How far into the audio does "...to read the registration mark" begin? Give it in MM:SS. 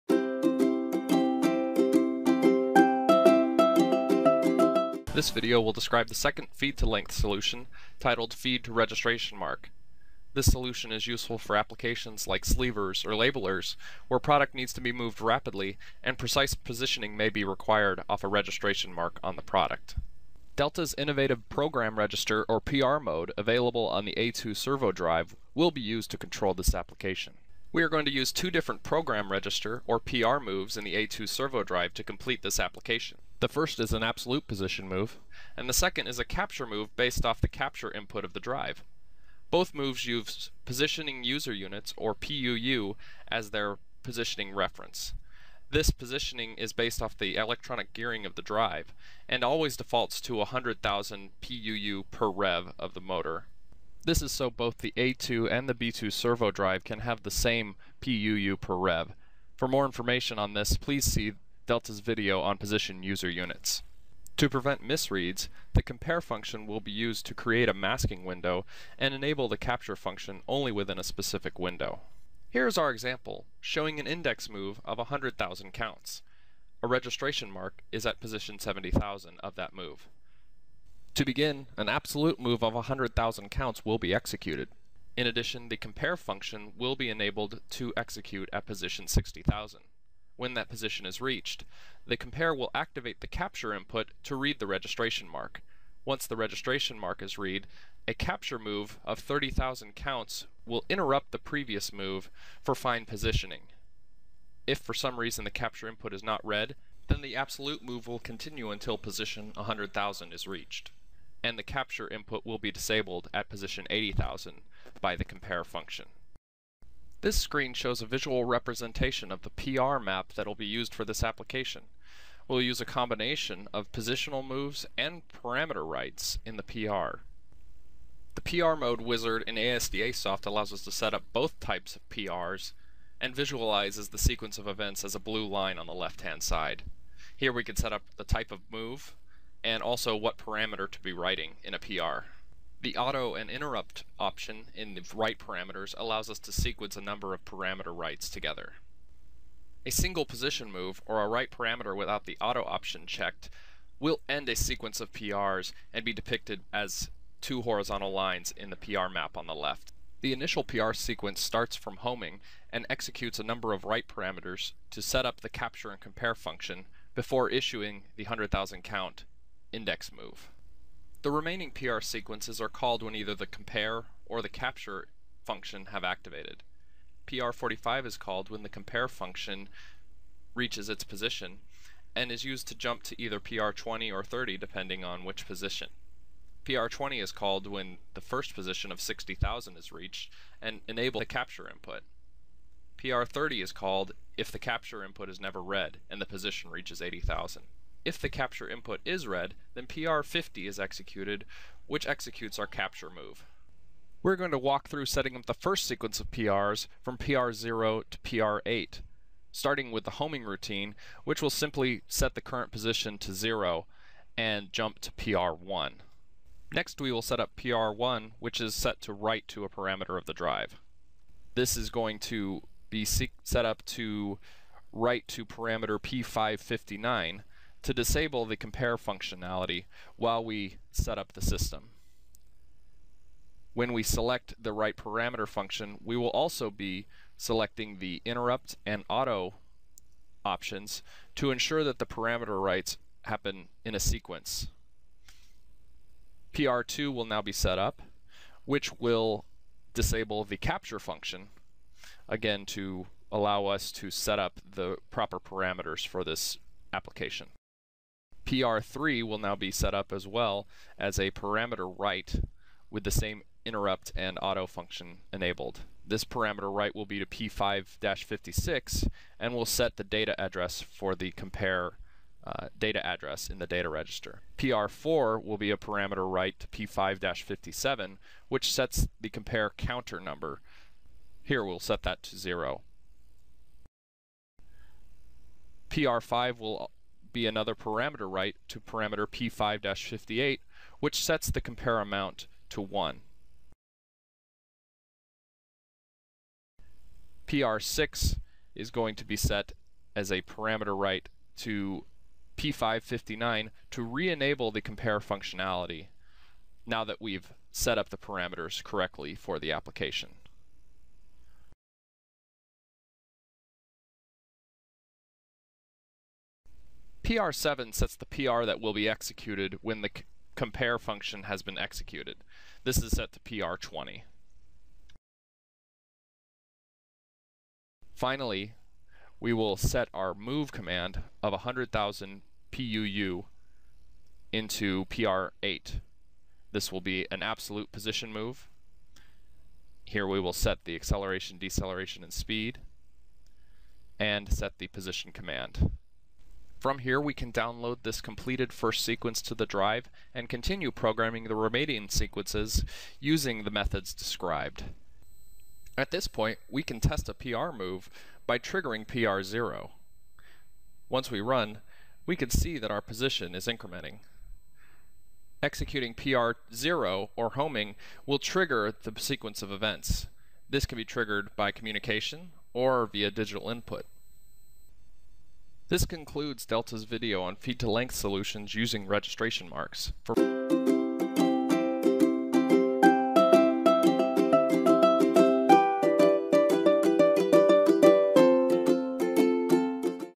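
01:34.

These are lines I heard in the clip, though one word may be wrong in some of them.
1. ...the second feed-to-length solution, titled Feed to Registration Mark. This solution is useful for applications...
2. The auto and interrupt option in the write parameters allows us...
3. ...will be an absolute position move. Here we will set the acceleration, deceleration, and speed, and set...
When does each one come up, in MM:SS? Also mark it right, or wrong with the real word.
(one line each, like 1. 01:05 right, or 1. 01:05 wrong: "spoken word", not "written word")
1. 00:06 right
2. 02:22 right
3. 05:36 right.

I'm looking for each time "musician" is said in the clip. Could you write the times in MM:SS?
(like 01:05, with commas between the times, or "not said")
not said.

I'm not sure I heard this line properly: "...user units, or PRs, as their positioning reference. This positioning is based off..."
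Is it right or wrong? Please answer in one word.
wrong.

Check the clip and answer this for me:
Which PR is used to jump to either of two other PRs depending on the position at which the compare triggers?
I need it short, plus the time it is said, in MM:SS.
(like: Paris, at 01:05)
PR45, at 02:57.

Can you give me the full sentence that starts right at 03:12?
PR30 is called if the capture input is never read and the position reaches 80,000.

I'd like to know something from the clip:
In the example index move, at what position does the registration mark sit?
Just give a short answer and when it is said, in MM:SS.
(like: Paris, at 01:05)
70,000, at 01:18.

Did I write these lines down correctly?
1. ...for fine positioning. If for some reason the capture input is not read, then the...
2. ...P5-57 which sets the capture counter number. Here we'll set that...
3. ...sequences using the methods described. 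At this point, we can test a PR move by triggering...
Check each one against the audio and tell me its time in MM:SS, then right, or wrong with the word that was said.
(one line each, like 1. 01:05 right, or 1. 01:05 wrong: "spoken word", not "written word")
1. 01:42 right
2. 04:36 wrong: "compare", not "capture"
3. 05:52 right.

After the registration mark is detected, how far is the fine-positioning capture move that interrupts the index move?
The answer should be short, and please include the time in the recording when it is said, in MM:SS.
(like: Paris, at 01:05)
30,000 counts, at 01:39.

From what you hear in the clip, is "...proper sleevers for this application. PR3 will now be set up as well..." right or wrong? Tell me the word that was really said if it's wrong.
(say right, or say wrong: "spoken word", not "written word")
wrong: "parameters", not "sleevers".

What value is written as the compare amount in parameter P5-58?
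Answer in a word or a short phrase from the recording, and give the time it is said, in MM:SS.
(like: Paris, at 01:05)
1, at 04:52.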